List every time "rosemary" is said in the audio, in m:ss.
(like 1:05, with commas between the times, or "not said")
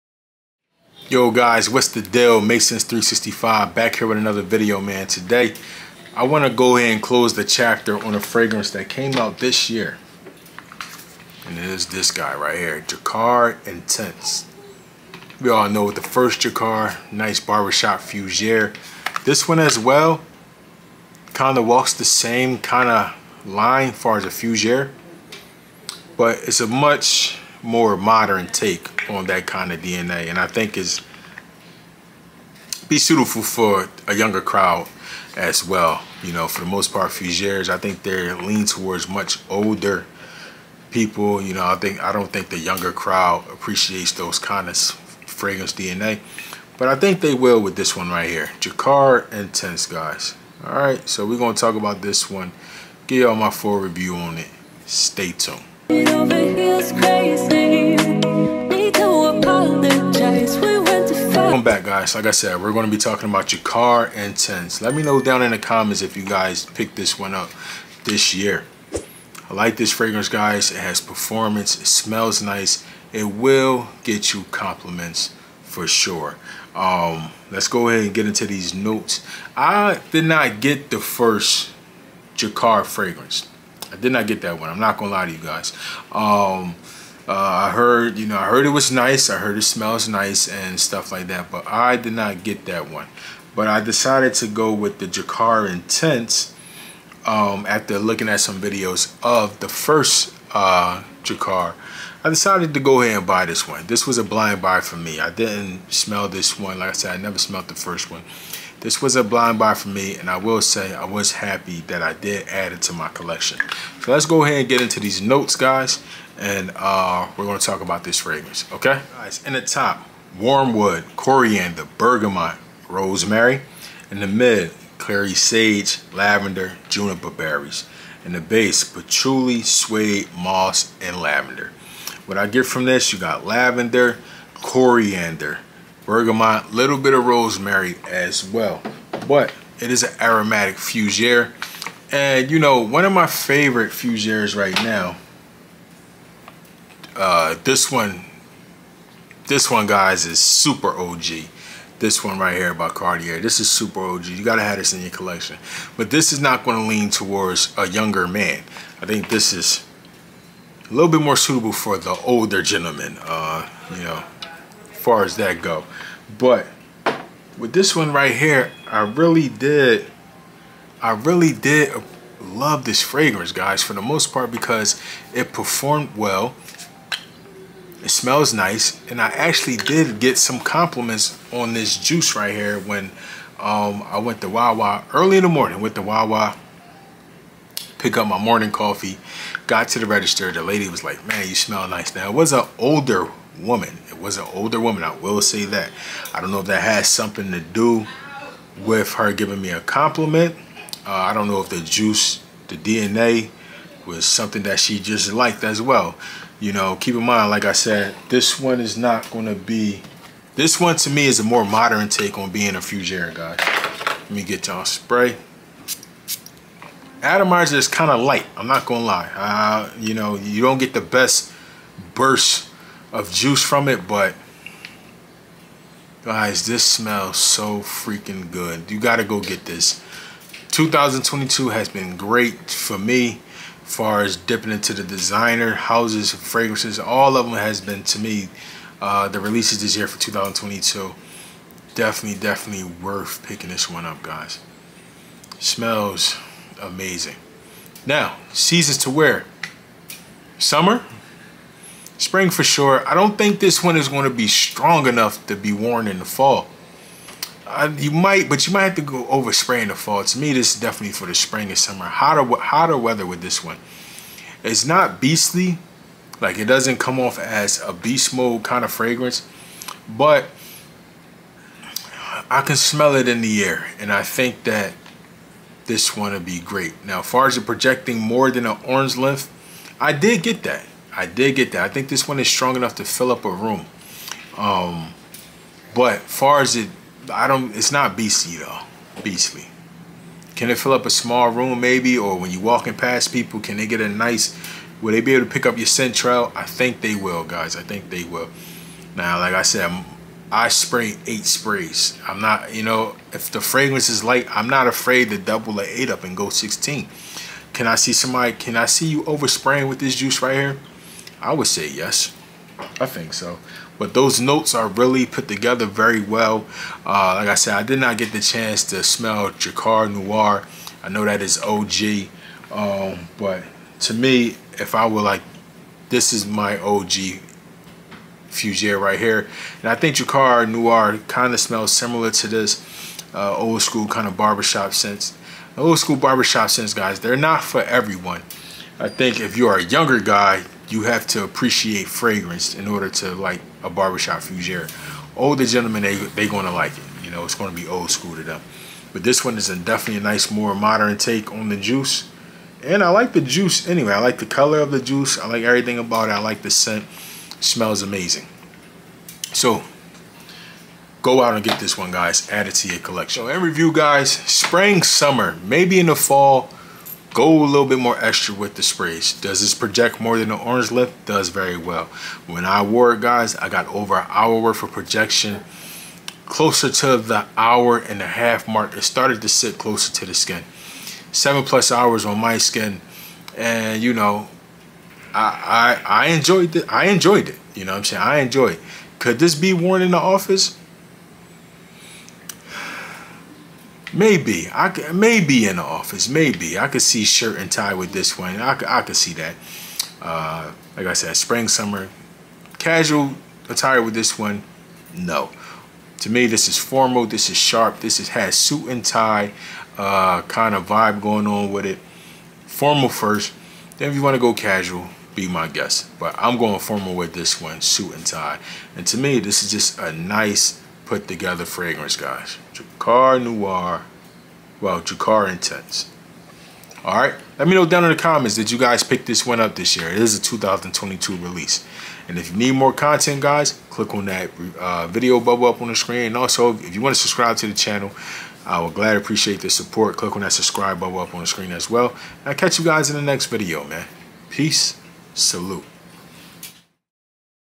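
2:02, 2:17.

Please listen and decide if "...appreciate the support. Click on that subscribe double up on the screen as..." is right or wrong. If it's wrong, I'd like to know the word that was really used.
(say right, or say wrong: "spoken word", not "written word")
wrong: "bubble", not "double".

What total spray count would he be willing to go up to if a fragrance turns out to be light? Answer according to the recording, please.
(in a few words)
16.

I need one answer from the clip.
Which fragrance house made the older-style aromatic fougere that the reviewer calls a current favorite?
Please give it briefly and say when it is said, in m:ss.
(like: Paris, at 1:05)
Cartier, at 2:32.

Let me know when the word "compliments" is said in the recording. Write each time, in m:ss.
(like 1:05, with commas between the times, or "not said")
1:14, 3:00, 3:19.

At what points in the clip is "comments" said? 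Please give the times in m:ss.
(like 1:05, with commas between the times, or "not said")
1:05, 7:08.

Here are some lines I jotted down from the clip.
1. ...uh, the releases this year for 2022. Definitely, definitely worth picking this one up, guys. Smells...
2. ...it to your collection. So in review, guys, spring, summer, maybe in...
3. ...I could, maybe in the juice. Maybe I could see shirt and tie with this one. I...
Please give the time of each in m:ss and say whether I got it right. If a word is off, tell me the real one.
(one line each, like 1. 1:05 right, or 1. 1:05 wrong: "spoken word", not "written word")
1. 3:59 right
2. 6:02 right
3. 6:34 wrong: "office", not "juice".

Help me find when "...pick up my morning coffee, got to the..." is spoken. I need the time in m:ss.
3:07.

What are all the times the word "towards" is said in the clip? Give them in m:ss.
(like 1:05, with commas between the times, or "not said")
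0:38, 2:37.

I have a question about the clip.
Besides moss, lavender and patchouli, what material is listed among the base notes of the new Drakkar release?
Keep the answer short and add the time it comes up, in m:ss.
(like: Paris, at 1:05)
Suede, at 2:09.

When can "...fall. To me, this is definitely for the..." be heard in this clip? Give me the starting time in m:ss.
4:19.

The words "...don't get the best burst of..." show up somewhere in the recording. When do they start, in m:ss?
3:40.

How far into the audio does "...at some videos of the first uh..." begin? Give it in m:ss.
1:38.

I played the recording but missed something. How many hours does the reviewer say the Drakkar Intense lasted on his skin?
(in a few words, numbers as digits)
7+ hours.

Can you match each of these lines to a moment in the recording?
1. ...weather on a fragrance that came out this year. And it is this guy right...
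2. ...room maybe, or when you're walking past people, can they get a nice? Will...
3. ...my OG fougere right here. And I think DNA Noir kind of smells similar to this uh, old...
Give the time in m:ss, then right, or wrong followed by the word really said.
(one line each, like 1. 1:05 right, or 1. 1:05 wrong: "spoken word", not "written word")
1. 0:07 wrong: "chapter", not "weather"
2. 4:51 right
3. 5:26 wrong: "Drakkar", not "DNA".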